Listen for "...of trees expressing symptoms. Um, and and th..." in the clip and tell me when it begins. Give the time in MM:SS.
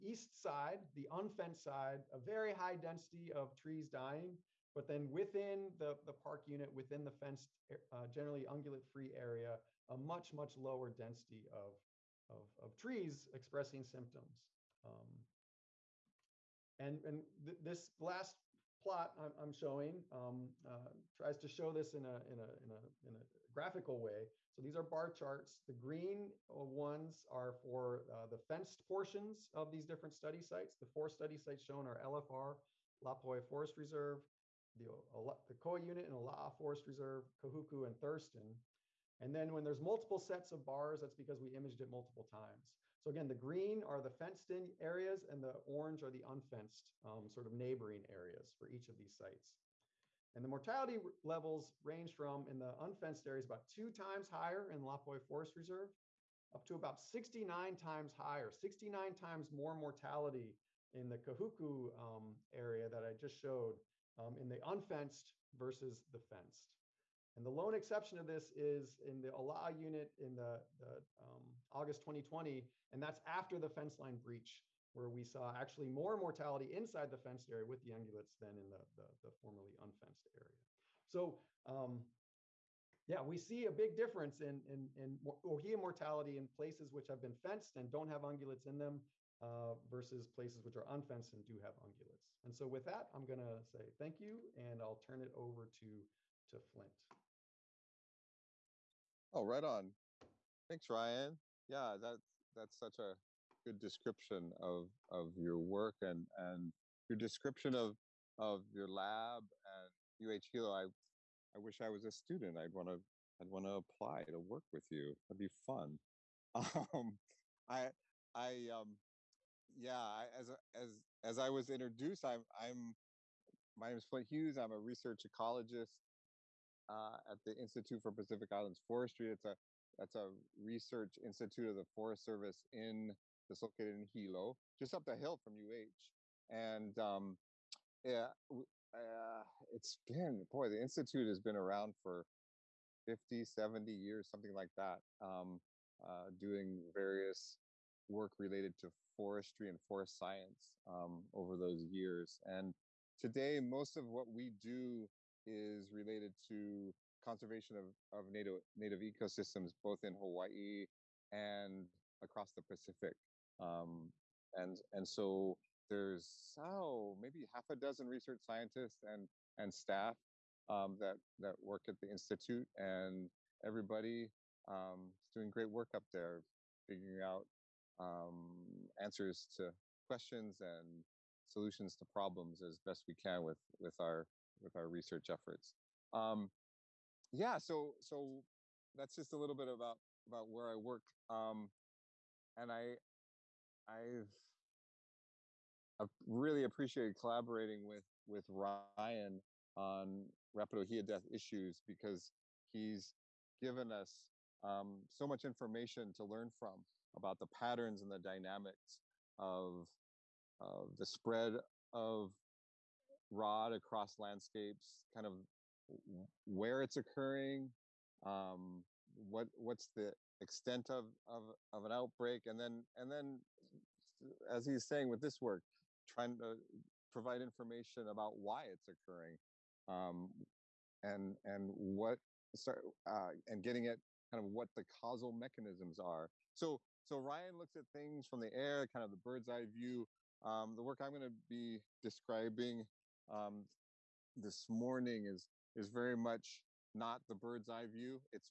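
00:12.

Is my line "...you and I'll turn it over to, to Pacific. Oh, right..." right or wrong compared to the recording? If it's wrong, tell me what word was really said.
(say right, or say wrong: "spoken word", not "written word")
wrong: "Flint", not "Pacific".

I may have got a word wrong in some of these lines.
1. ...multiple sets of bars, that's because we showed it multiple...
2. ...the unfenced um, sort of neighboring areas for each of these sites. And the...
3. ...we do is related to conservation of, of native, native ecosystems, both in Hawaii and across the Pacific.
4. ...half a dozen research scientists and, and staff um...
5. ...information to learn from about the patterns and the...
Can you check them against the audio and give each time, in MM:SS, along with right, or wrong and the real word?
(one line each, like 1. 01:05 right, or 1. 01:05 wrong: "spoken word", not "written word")
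1. 00:39 wrong: "imaged", not "showed"
2. 00:46 right
3. 02:34 right
4. 02:47 right
5. 03:25 right.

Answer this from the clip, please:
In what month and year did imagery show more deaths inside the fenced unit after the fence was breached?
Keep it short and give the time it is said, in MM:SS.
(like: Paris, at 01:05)
August 2020, at 01:11.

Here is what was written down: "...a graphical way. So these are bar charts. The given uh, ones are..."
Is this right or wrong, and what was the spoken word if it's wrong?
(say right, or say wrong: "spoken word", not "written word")
wrong: "green", not "given".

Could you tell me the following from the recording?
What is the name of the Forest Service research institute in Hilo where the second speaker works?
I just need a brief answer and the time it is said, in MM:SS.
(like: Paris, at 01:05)
Institute for Pacific Islands Forestry, at 02:07.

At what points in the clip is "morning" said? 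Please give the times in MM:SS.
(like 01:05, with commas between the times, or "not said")
04:04.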